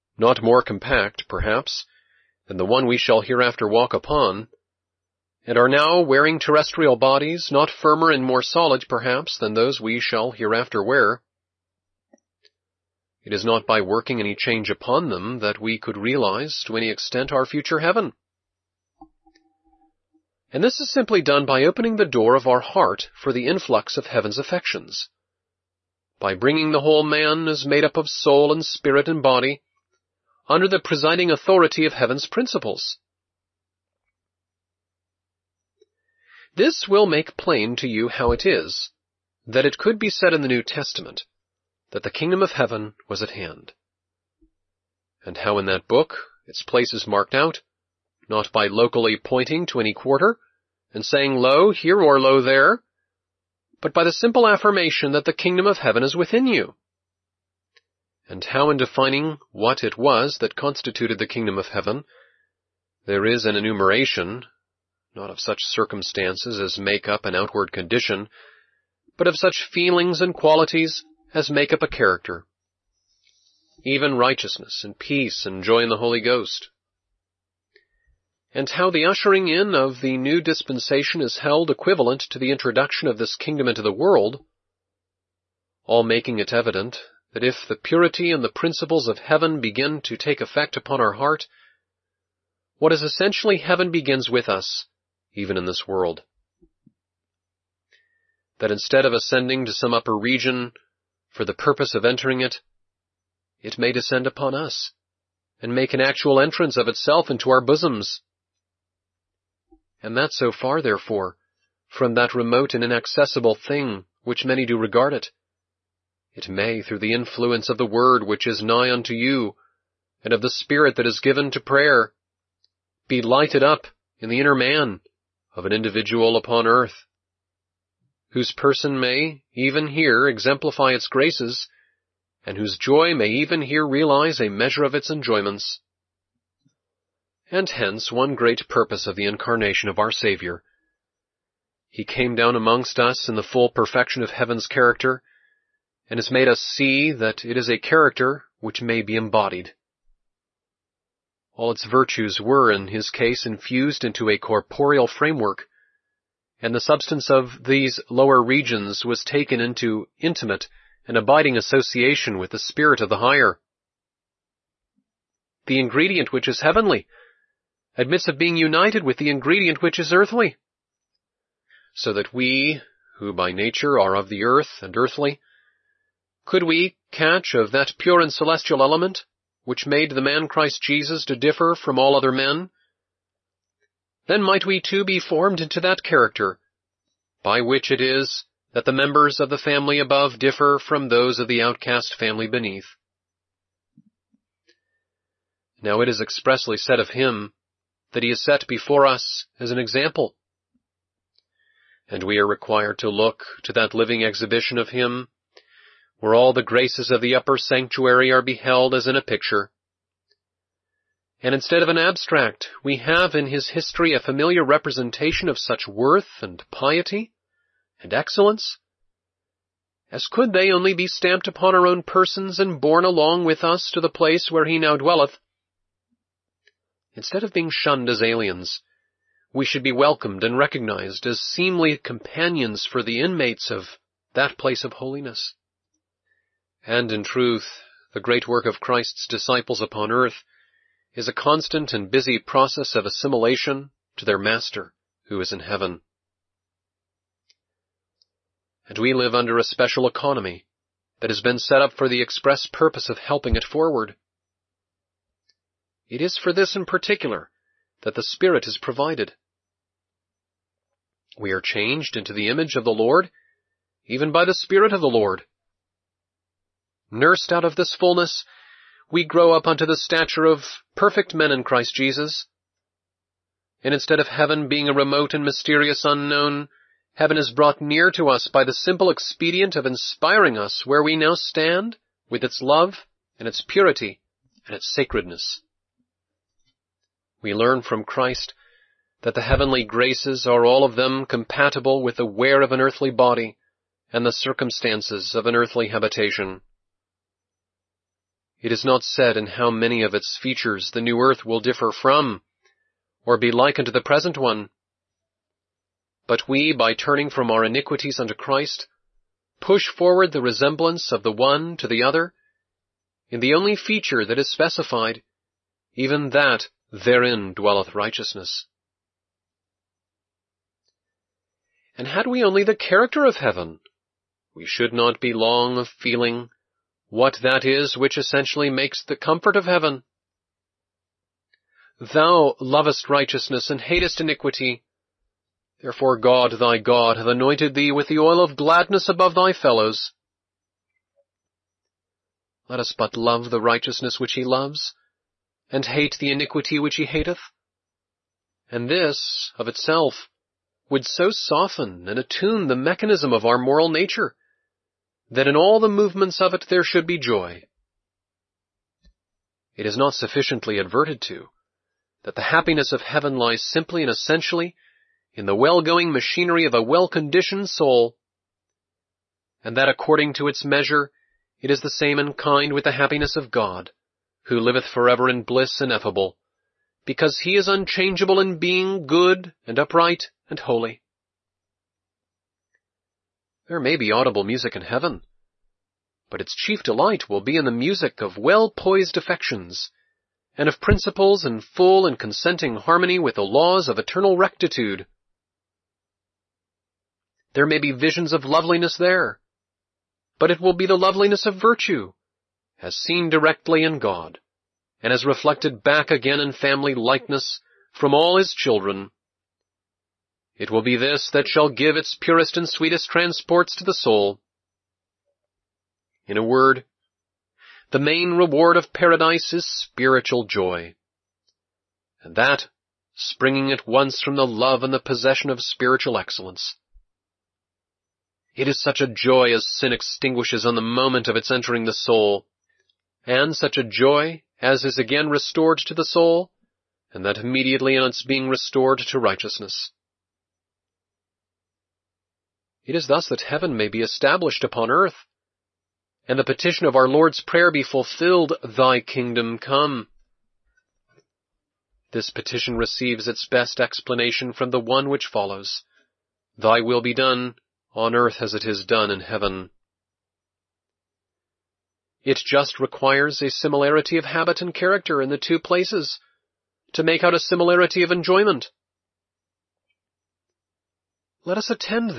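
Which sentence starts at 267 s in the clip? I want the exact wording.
Nursed out of this fullness we grow up unto the stature of perfect men in Christ Jesus.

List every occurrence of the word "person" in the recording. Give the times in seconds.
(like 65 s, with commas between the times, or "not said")
128 s, 222 s.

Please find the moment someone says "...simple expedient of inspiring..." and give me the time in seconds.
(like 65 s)
278 s.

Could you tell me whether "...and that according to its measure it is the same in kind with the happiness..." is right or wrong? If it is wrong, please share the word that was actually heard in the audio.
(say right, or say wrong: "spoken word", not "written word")
right.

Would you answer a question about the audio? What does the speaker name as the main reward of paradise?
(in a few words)
Spiritual joy.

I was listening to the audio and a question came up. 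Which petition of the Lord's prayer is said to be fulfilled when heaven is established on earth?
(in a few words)
Thy kingdom come.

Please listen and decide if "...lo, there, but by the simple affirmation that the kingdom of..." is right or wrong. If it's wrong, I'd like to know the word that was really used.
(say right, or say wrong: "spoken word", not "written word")
right.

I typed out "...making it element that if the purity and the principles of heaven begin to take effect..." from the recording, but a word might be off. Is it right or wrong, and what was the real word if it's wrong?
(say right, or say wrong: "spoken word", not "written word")
wrong: "evident", not "element".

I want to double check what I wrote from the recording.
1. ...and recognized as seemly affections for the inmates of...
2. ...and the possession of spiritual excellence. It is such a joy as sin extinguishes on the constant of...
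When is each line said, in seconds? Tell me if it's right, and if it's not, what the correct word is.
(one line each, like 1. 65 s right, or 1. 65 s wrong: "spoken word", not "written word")
1. 230 s wrong: "companions", not "affections"
2. 424 s wrong: "moment", not "constant".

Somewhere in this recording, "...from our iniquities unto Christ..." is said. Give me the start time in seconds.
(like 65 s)
307 s.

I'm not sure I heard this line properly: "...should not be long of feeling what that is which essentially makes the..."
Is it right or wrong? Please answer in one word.
right.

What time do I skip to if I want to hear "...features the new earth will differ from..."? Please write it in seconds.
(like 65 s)
300 s.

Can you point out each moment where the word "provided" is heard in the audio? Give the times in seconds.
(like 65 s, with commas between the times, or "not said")
258 s.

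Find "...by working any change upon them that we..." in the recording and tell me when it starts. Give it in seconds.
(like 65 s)
13 s.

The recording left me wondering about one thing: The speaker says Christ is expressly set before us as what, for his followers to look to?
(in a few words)
An example.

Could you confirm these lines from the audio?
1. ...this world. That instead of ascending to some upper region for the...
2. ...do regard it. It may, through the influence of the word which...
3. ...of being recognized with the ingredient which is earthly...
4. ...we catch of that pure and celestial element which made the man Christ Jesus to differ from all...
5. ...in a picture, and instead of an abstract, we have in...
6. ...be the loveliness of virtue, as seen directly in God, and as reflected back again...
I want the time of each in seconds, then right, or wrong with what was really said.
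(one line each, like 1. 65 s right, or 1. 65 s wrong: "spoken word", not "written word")
1. 95 s right
2. 114 s right
3. 168 s wrong: "united", not "recognized"
4. 176 s right
5. 209 s right
6. 400 s right.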